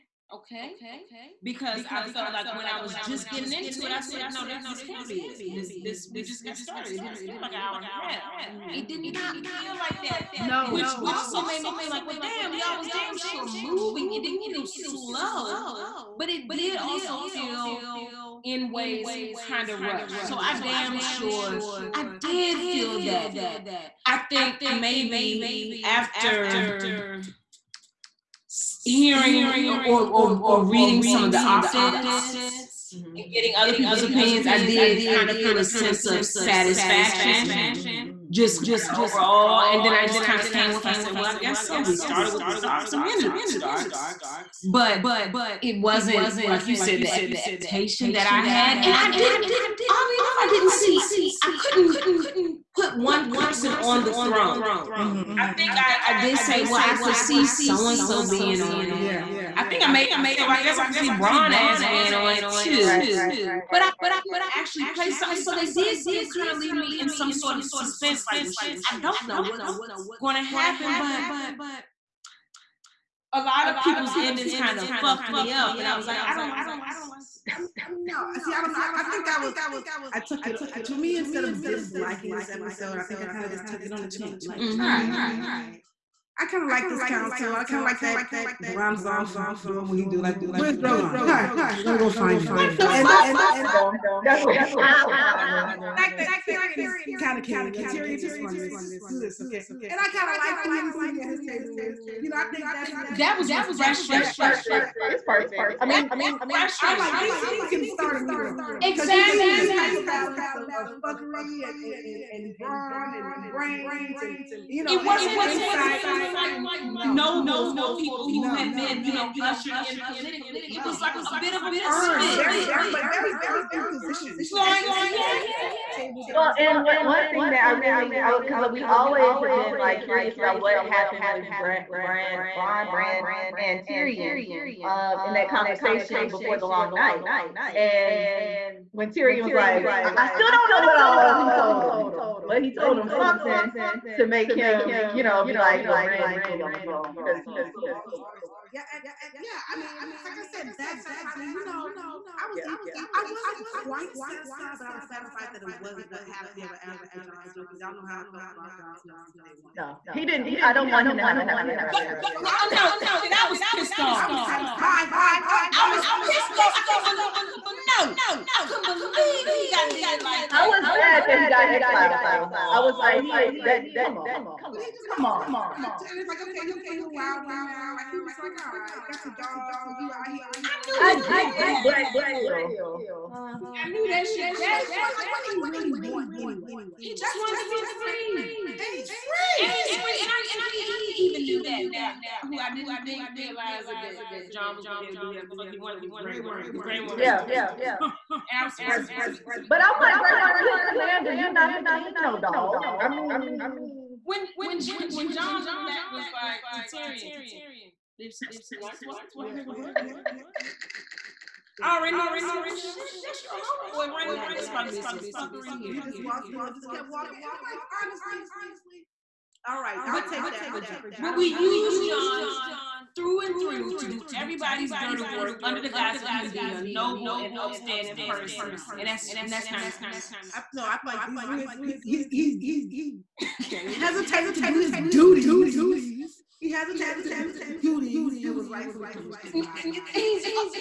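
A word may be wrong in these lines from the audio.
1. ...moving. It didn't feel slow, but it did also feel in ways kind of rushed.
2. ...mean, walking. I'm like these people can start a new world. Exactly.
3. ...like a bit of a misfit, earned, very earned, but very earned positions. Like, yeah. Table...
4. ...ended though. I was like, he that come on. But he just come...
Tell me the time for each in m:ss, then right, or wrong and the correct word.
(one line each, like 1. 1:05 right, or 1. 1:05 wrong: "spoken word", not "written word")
1. 0:13 right
2. 1:45 wrong: "refreshing", not "walking"
3. 2:00 right
4. 2:51 wrong: "exiled", not "ended".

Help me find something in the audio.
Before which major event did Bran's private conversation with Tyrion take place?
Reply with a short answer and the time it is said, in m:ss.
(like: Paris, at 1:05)
the long night, at 2:16.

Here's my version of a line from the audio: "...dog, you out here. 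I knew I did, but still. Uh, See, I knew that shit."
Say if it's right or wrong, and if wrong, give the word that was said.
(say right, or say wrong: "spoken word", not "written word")
right.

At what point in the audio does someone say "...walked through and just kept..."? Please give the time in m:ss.
3:36.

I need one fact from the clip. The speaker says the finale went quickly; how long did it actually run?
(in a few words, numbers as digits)
an hour and a half.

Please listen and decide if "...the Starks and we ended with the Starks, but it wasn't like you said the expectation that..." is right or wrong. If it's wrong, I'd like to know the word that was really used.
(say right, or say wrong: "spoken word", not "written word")
right.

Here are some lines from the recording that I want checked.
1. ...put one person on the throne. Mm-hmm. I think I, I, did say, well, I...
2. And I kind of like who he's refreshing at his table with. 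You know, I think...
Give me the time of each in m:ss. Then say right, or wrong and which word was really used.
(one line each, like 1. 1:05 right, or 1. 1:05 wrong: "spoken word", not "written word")
1. 0:52 right
2. 1:39 wrong: "sitting", not "refreshing".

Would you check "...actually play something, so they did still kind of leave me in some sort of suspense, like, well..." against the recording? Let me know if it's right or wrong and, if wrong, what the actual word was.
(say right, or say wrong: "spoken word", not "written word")
right.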